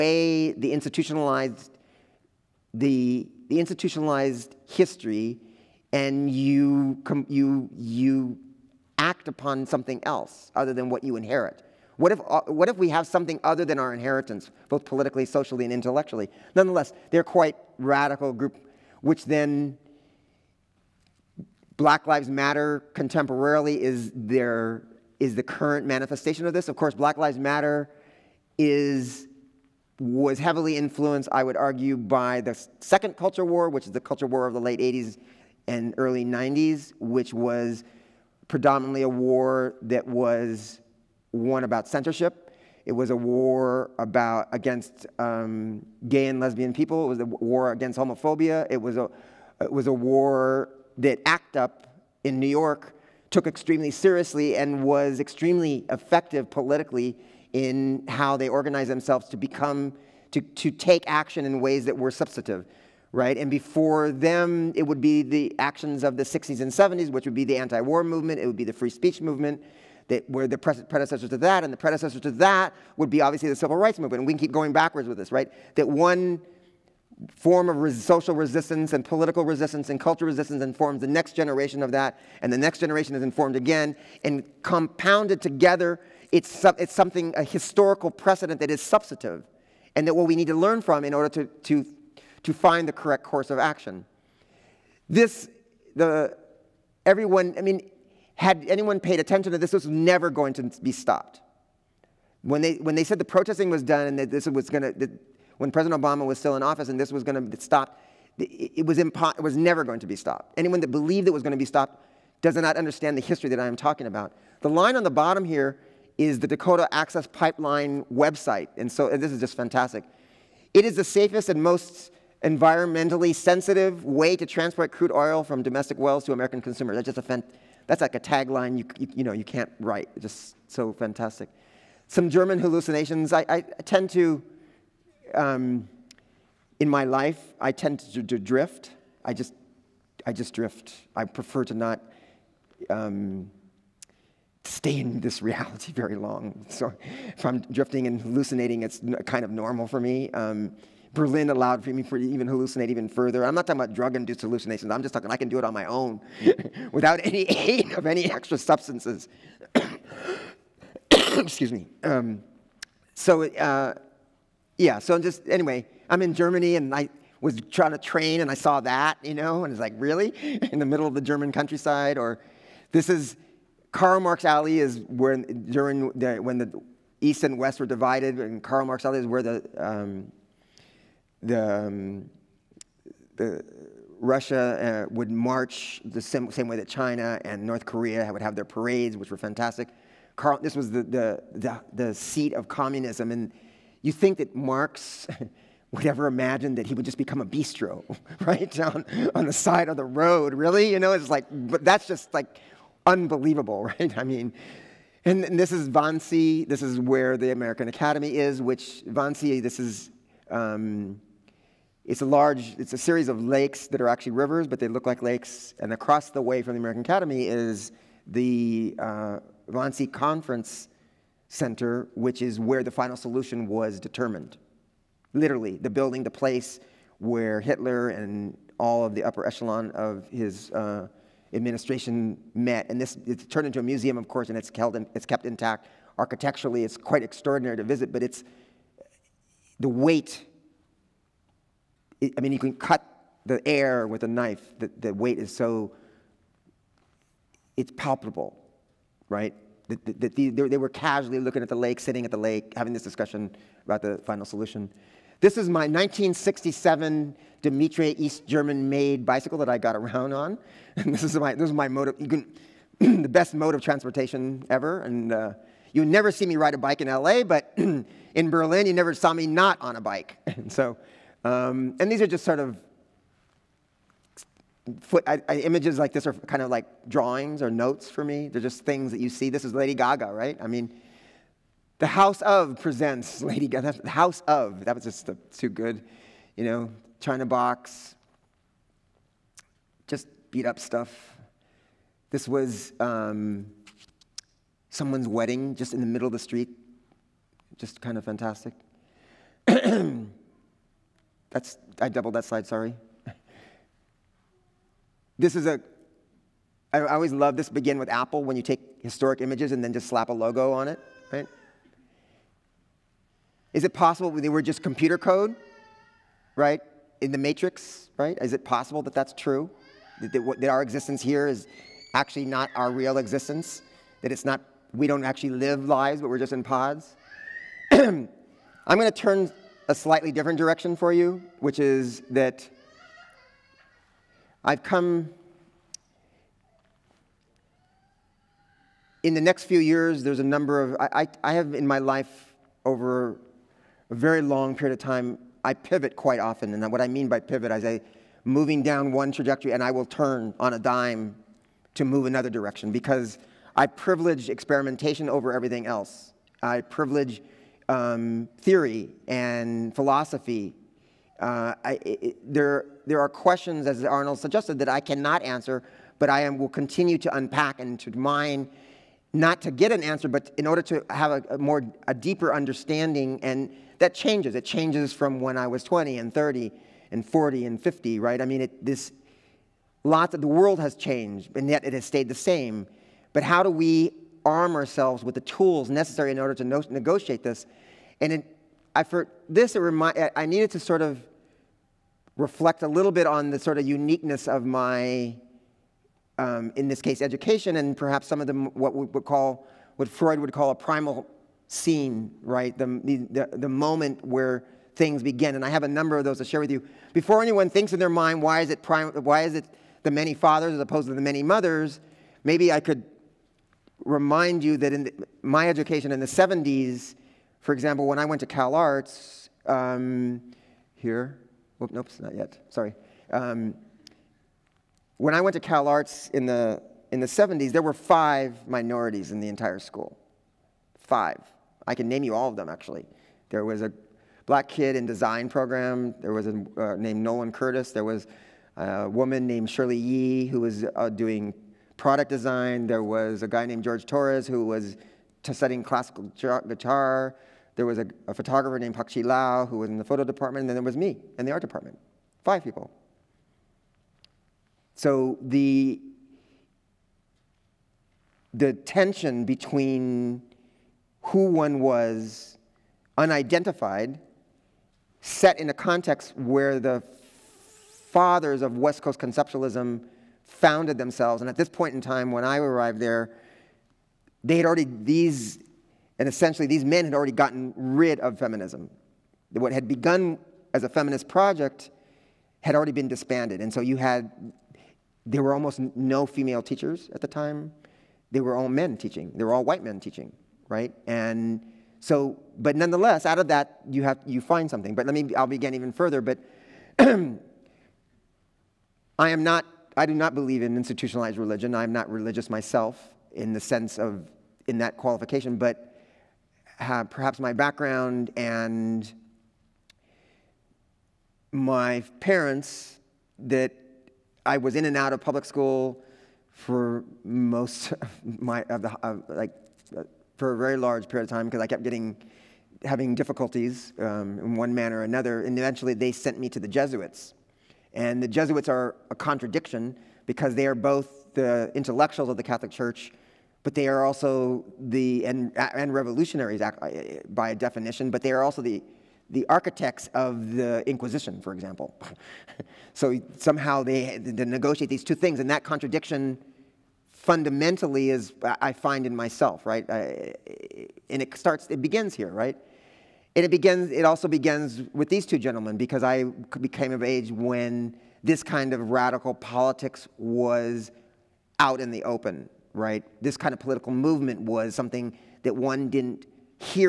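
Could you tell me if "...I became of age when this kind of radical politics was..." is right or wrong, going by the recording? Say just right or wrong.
right.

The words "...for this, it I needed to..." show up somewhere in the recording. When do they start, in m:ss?
6:29.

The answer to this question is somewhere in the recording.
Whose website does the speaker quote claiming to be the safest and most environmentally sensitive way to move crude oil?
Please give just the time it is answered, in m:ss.
1:56.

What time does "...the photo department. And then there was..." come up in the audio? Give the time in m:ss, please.
7:29.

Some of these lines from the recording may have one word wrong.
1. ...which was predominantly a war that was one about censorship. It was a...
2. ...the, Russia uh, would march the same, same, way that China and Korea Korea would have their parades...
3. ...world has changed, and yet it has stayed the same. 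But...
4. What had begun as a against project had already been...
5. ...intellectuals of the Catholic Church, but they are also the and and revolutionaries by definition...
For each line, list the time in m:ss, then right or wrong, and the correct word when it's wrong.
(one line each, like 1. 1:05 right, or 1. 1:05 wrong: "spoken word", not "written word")
1. 0:36 right
2. 3:03 wrong: "North", not "Korea"
3. 6:20 right
4. 7:59 wrong: "feminist", not "against"
5. 8:51 right.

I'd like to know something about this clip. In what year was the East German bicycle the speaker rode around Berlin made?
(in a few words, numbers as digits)
1967.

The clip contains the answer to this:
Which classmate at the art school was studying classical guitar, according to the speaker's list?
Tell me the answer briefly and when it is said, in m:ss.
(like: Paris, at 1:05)
George Torres, at 7:23.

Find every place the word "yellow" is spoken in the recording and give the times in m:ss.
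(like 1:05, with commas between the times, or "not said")
not said.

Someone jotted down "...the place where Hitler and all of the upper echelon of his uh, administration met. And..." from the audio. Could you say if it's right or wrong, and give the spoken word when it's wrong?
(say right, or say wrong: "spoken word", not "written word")
right.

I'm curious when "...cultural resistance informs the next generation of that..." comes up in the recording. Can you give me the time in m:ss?
1:19.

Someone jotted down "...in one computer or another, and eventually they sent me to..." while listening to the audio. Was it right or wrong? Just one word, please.
wrong.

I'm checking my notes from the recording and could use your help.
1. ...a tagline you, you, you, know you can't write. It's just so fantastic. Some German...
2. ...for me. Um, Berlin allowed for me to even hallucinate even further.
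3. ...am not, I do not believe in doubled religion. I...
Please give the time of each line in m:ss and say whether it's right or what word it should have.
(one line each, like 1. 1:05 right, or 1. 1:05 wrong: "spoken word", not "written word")
1. 2:08 right
2. 2:29 right
3. 8:17 wrong: "institutionalized", not "doubled".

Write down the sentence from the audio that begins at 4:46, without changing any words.
You know, China Box, just beat up stuff.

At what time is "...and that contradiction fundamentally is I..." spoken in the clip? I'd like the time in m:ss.
9:05.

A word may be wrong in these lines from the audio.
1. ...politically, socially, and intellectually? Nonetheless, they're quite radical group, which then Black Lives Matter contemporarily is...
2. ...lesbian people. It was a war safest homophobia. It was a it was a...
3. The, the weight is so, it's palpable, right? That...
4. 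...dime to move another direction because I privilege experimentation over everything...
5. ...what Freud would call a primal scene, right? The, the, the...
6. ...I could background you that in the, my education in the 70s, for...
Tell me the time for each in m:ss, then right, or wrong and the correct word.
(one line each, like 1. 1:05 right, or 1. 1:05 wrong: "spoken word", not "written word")
1. 0:14 right
2. 0:46 wrong: "against", not "safest"
3. 4:04 right
4. 5:50 right
5. 6:39 right
6. 6:52 wrong: "remind", not "background".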